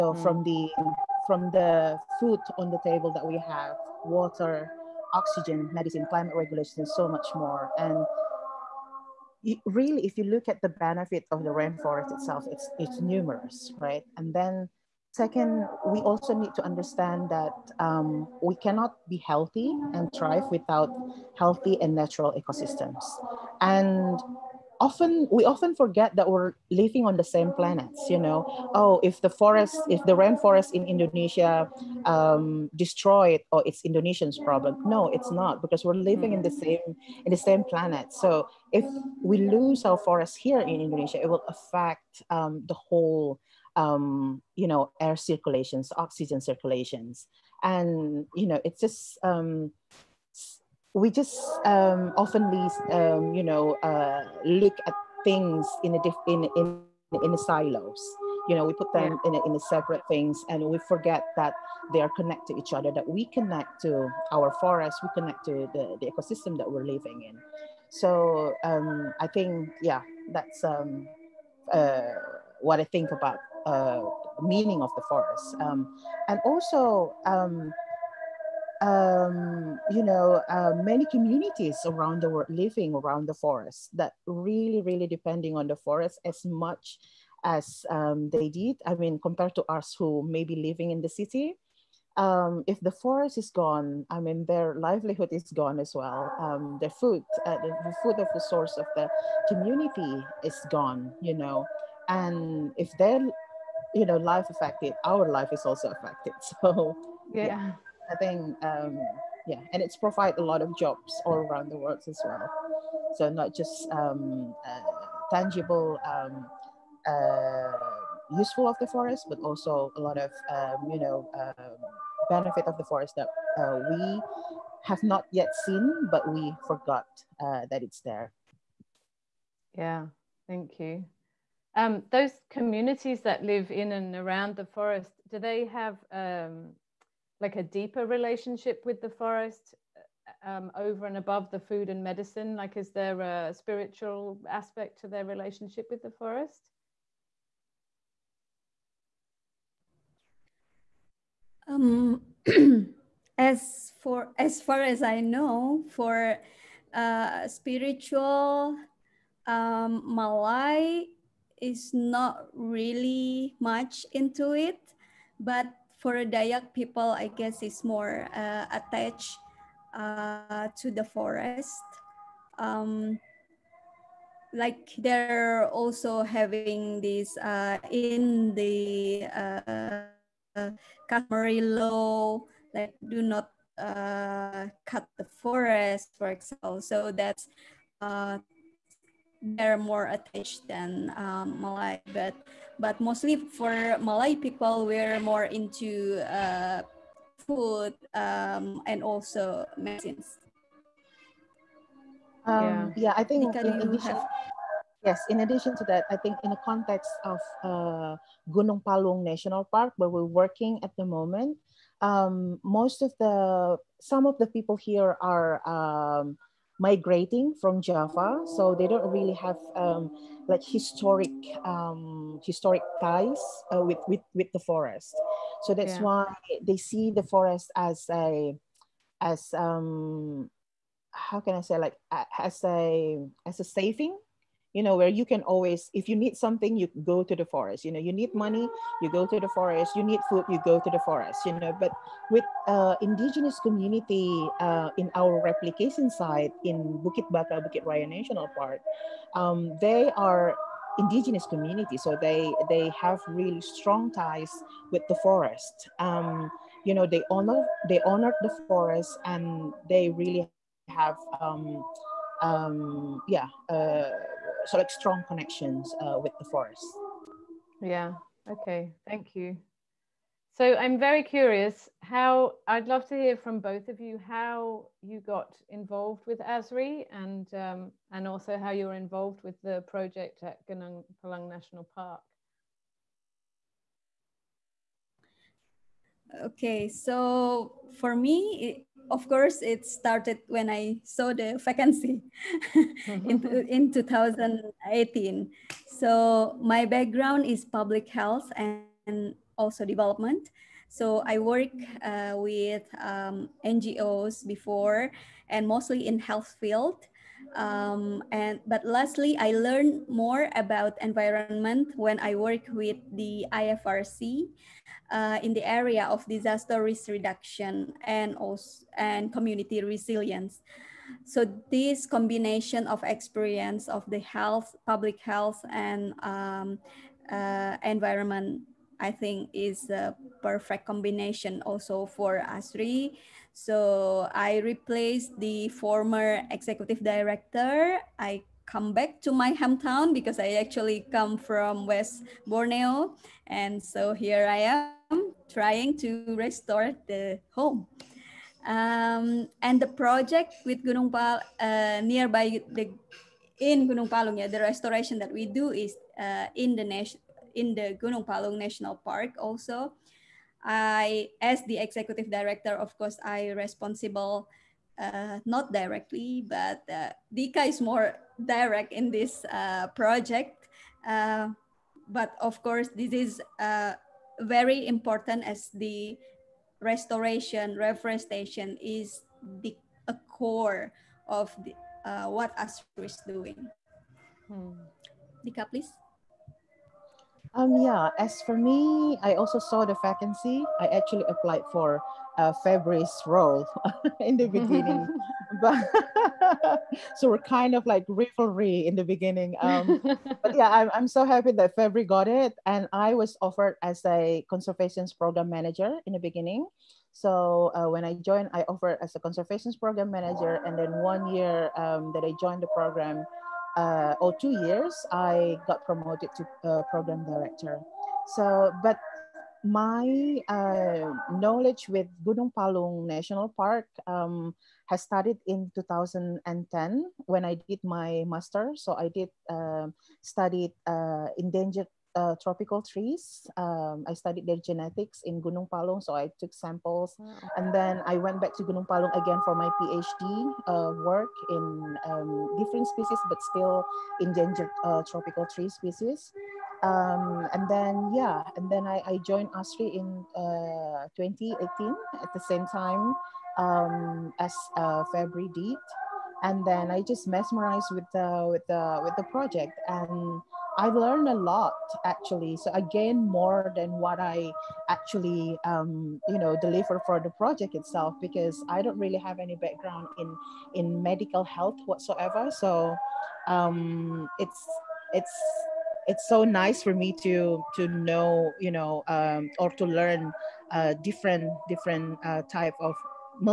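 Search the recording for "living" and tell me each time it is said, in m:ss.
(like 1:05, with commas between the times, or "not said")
0:26, 0:36, 1:06, 1:22, 1:30.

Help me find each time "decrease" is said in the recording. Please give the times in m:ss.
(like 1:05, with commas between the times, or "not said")
not said.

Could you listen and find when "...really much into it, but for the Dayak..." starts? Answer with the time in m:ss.
2:42.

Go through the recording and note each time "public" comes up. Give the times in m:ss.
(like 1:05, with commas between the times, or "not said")
4:57, 5:24.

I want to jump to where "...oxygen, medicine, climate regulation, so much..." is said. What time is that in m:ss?
0:05.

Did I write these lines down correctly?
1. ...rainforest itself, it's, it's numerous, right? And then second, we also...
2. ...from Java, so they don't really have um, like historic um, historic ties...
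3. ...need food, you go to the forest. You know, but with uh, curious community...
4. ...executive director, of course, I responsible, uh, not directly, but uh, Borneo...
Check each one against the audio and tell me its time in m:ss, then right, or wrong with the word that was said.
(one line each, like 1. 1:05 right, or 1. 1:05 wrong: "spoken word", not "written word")
1. 0:11 right
2. 3:37 right
3. 4:00 wrong: "indigenous", not "curious"
4. 6:01 wrong: "Dika", not "Borneo".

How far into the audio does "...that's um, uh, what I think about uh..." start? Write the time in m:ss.
1:10.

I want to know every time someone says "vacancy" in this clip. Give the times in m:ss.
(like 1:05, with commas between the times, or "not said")
4:51, 6:30.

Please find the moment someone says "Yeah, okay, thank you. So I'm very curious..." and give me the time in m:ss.
4:27.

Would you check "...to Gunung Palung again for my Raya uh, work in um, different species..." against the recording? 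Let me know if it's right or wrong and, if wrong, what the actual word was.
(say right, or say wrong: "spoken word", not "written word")
wrong: "PhD", not "Raya".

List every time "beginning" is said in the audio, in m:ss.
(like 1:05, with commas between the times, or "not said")
6:34, 6:39, 6:46.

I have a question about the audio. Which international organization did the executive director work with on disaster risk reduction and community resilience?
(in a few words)
IFRC.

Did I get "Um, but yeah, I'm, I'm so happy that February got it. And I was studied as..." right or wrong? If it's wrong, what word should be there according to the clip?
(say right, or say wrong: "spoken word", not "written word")
wrong: "offered", not "studied".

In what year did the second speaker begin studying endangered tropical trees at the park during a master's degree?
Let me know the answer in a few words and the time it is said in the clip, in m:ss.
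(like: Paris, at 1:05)
2010, at 7:05.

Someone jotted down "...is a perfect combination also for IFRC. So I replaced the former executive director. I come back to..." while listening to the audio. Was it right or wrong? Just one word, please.
wrong.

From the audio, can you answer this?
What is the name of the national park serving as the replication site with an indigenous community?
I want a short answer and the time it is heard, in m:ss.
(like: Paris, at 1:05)
Bukit Baka, Bukit Raya National Park, at 4:07.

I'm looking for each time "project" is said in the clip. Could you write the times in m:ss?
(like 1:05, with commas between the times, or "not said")
4:39, 5:49, 6:09, 7:39, 7:47.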